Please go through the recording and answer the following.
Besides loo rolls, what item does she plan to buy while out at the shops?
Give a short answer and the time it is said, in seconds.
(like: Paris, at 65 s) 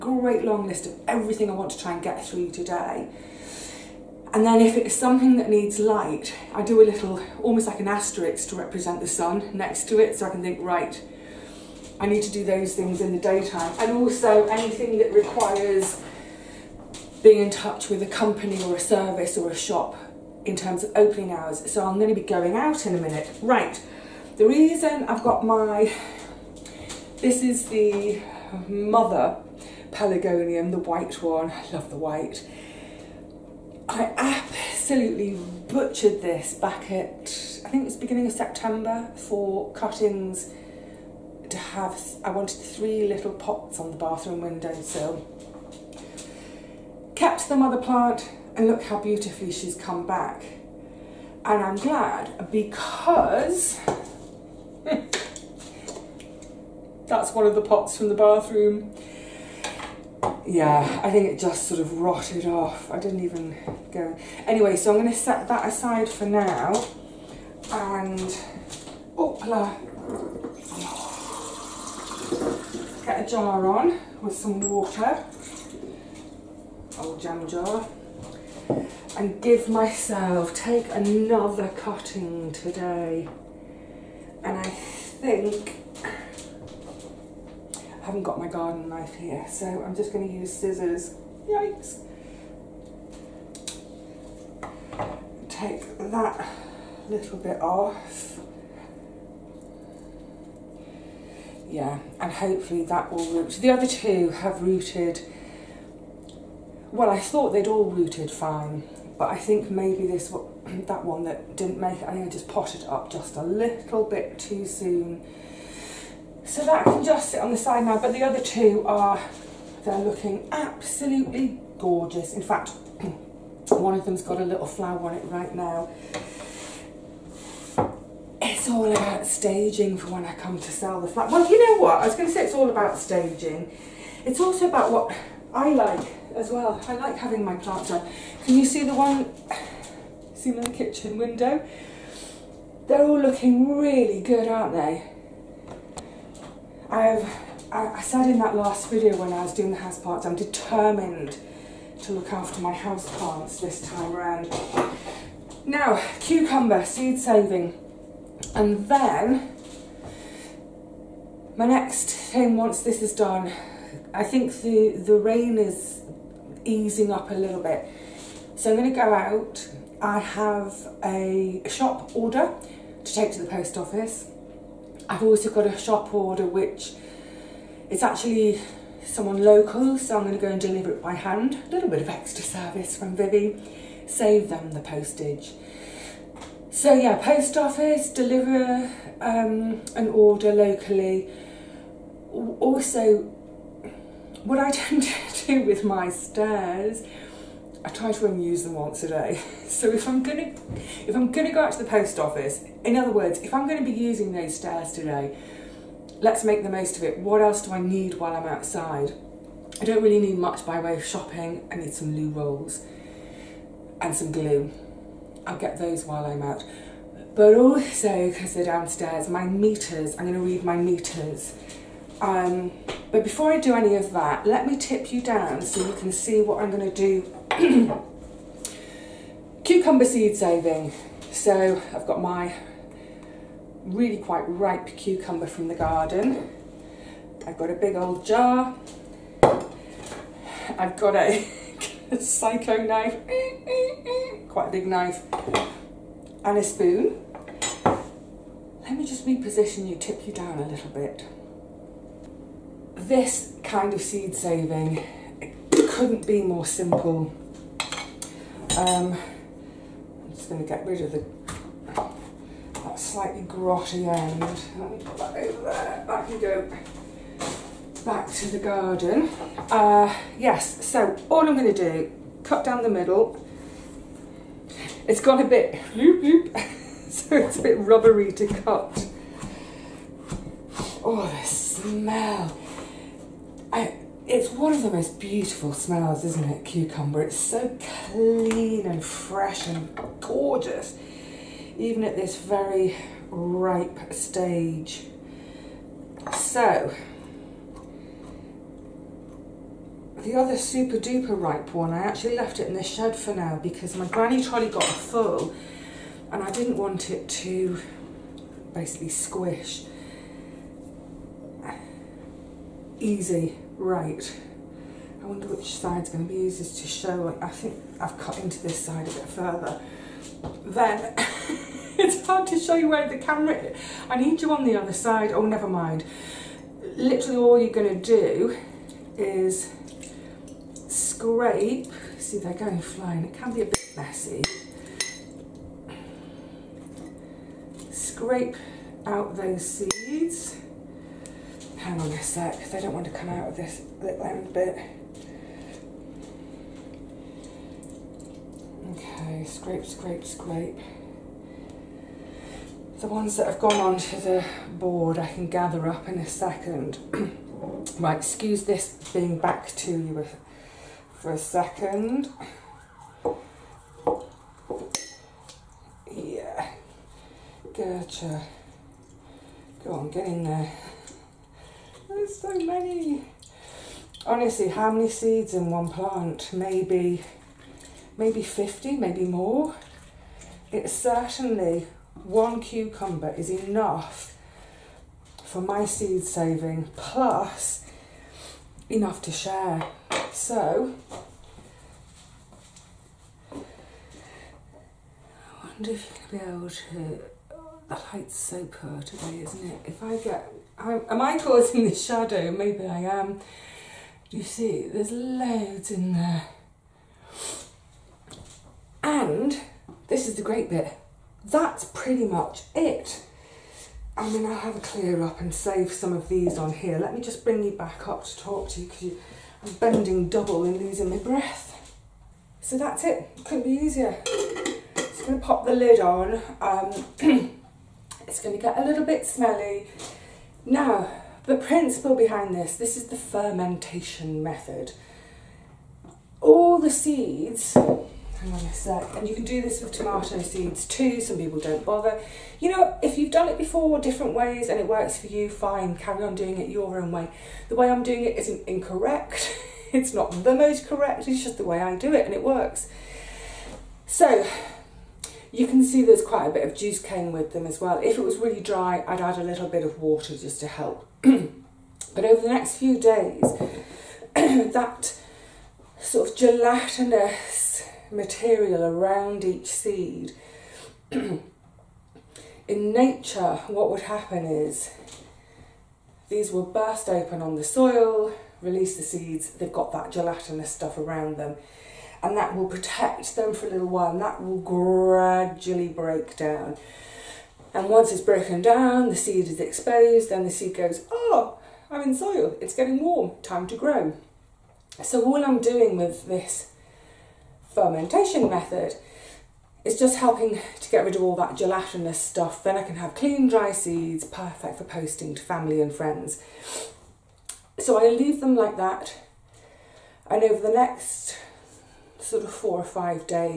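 glue, at 214 s.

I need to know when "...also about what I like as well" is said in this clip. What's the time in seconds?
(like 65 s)
134 s.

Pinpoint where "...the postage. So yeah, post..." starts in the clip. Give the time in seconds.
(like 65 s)
184 s.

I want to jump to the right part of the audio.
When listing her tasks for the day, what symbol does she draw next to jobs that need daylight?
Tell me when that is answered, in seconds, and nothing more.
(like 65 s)
7 s.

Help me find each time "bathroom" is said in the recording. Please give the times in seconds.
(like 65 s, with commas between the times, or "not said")
43 s, 58 s.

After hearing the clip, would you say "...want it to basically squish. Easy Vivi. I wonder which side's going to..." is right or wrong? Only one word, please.
wrong.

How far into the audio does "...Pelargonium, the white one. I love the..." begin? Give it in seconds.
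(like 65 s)
29 s.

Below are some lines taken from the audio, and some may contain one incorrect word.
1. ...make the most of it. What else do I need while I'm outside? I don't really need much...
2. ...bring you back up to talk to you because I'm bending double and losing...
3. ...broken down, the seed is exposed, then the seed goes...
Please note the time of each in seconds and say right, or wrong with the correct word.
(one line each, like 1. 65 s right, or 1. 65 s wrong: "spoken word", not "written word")
1. 206 s right
2. 417 s right
3. 488 s right.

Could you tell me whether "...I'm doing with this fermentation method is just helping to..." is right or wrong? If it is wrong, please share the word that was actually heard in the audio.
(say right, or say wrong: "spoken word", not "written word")
right.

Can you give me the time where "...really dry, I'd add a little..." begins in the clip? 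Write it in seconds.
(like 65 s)
458 s.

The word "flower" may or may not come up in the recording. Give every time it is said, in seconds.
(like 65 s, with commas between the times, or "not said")
124 s.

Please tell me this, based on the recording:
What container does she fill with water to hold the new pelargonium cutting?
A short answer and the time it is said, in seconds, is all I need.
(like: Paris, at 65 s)
old jam jar, at 77 s.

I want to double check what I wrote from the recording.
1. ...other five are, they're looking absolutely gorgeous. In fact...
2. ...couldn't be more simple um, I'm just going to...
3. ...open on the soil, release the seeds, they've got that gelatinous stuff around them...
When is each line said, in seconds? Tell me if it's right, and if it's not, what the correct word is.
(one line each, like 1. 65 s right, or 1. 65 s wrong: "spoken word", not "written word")
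1. 118 s wrong: "two", not "five"
2. 255 s right
3. 477 s right.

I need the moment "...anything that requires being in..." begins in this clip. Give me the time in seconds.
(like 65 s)
14 s.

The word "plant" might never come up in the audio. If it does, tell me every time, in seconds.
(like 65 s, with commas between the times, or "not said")
47 s, 137 s, 153 s, 375 s.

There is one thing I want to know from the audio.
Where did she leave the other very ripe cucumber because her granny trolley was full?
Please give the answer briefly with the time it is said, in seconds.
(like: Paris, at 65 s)
shed, at 302 s.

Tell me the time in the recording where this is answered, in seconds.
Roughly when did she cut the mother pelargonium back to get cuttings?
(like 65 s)
37 s.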